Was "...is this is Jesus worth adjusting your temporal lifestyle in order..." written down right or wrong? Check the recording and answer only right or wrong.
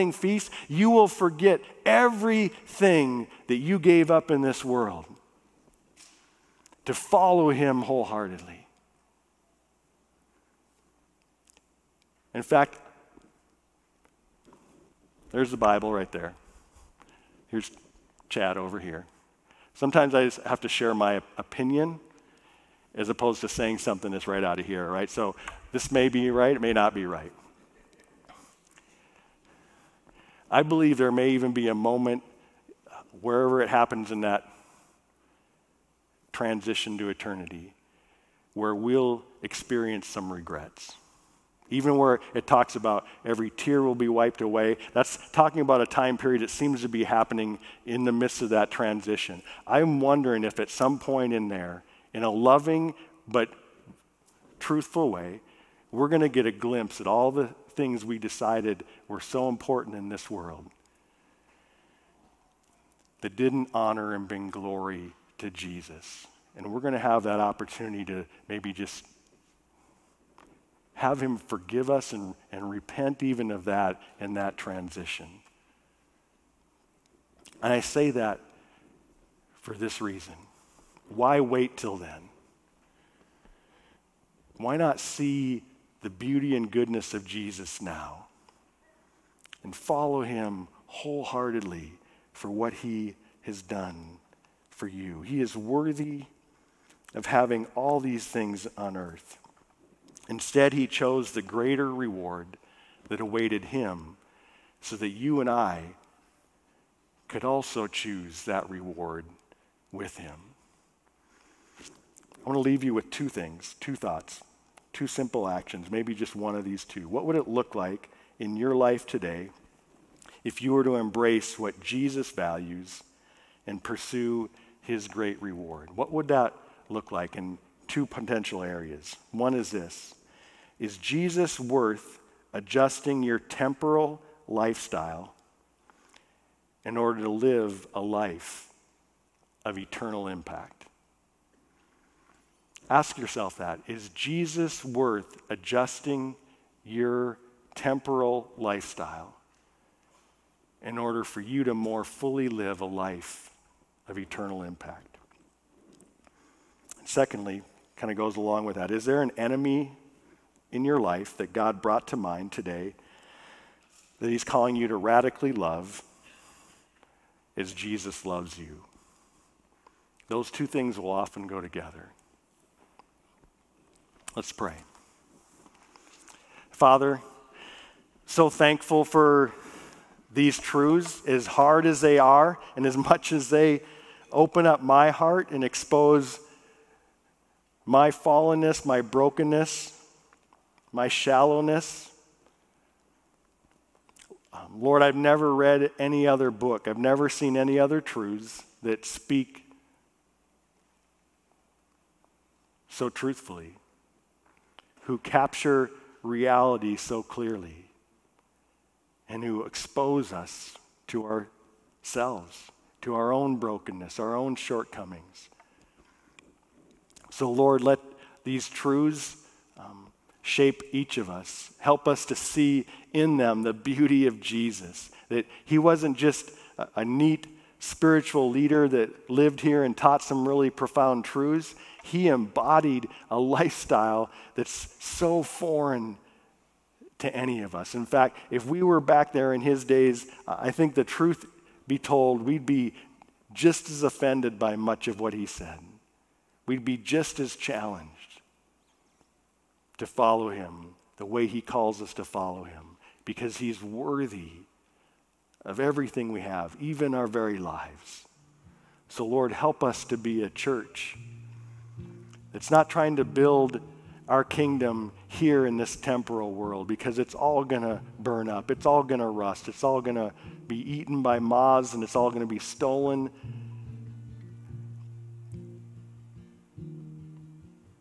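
right.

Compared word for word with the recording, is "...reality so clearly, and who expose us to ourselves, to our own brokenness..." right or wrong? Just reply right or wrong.
right.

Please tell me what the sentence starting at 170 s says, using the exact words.
Those two things will often go together.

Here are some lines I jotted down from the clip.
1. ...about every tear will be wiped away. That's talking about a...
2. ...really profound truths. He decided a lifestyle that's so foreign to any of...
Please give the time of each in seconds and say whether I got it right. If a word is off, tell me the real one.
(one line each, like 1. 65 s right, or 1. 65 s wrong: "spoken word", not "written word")
1. 42 s right
2. 230 s wrong: "embodied", not "decided".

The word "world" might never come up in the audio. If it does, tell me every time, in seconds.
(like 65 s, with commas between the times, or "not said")
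4 s, 60 s, 266 s.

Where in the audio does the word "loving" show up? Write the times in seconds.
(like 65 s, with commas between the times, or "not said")
52 s.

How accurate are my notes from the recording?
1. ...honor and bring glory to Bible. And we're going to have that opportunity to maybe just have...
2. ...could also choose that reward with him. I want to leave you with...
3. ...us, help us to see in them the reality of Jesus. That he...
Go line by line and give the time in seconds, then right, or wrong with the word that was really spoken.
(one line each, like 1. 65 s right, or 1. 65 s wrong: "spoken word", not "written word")
1. 63 s wrong: "Jesus", not "Bible"
2. 107 s right
3. 221 s wrong: "beauty", not "reality".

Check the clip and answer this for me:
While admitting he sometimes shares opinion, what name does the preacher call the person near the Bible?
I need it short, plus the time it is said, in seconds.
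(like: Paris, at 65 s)
Chad, at 18 s.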